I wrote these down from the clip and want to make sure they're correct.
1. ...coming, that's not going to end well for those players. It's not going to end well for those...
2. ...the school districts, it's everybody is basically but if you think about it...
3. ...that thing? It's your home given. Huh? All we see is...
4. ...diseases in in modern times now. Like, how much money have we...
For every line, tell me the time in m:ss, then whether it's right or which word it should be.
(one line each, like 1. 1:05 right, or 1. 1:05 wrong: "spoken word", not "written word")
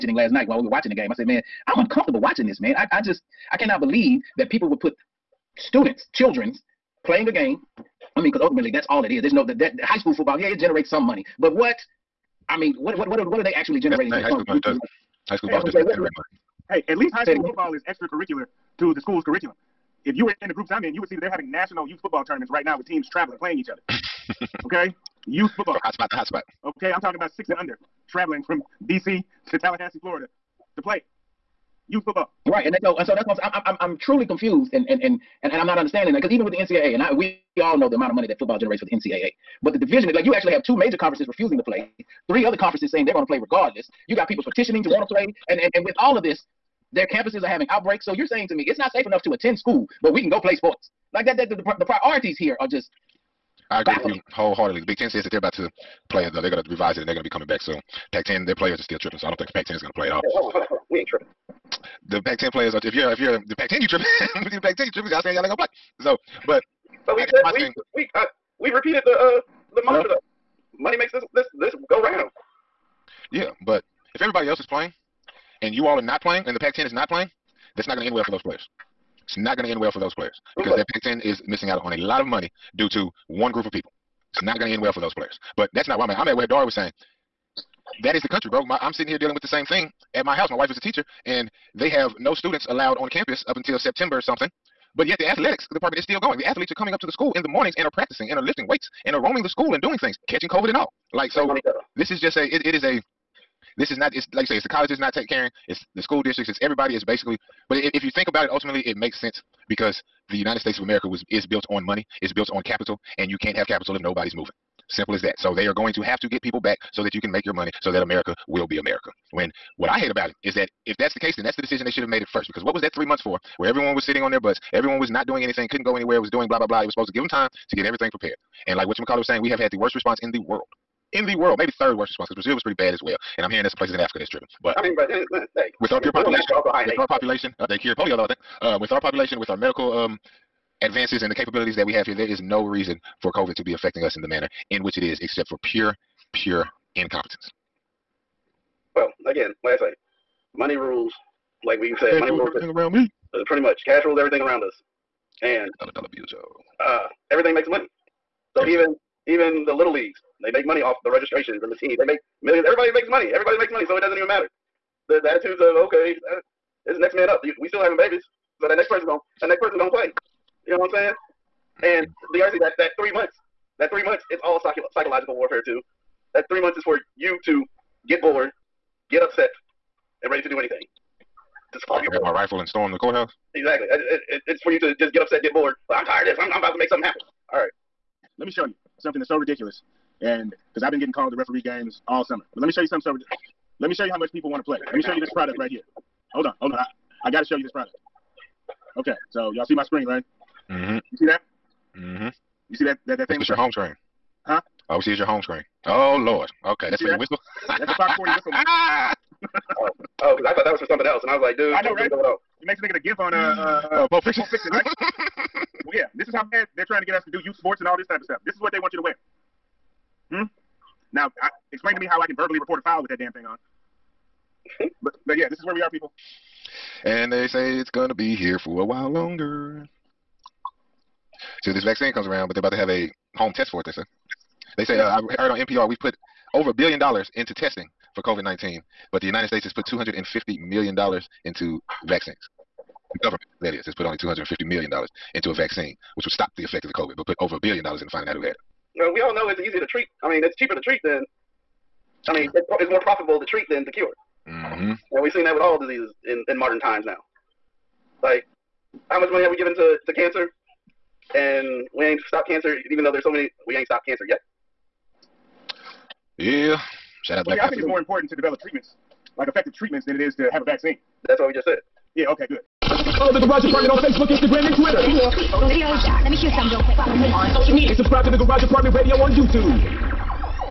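1. 1:17 wrong: "playing", not "coming"
2. 1:45 right
3. 3:23 wrong: "screen", not "given"
4. 4:15 right.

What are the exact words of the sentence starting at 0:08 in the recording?
I mean, because ultimately that's all it is.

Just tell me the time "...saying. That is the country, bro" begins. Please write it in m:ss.
1:26.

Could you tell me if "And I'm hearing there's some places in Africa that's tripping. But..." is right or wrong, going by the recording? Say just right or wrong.
right.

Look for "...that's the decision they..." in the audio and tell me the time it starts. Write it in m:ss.
2:01.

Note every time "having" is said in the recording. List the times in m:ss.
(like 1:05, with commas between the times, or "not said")
0:21, 0:47, 2:47.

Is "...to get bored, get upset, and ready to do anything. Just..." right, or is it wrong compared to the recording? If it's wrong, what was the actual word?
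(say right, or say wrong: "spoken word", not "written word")
right.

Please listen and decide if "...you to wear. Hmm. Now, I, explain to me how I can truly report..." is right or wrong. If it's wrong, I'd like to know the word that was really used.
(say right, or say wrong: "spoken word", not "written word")
wrong: "verbally", not "truly".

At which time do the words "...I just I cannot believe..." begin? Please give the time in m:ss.
0:02.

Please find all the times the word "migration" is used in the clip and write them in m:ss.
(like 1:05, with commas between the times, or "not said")
not said.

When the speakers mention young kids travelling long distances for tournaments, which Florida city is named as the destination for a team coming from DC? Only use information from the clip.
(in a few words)
Tallahassee.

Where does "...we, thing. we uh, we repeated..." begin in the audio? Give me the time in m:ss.
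1:07.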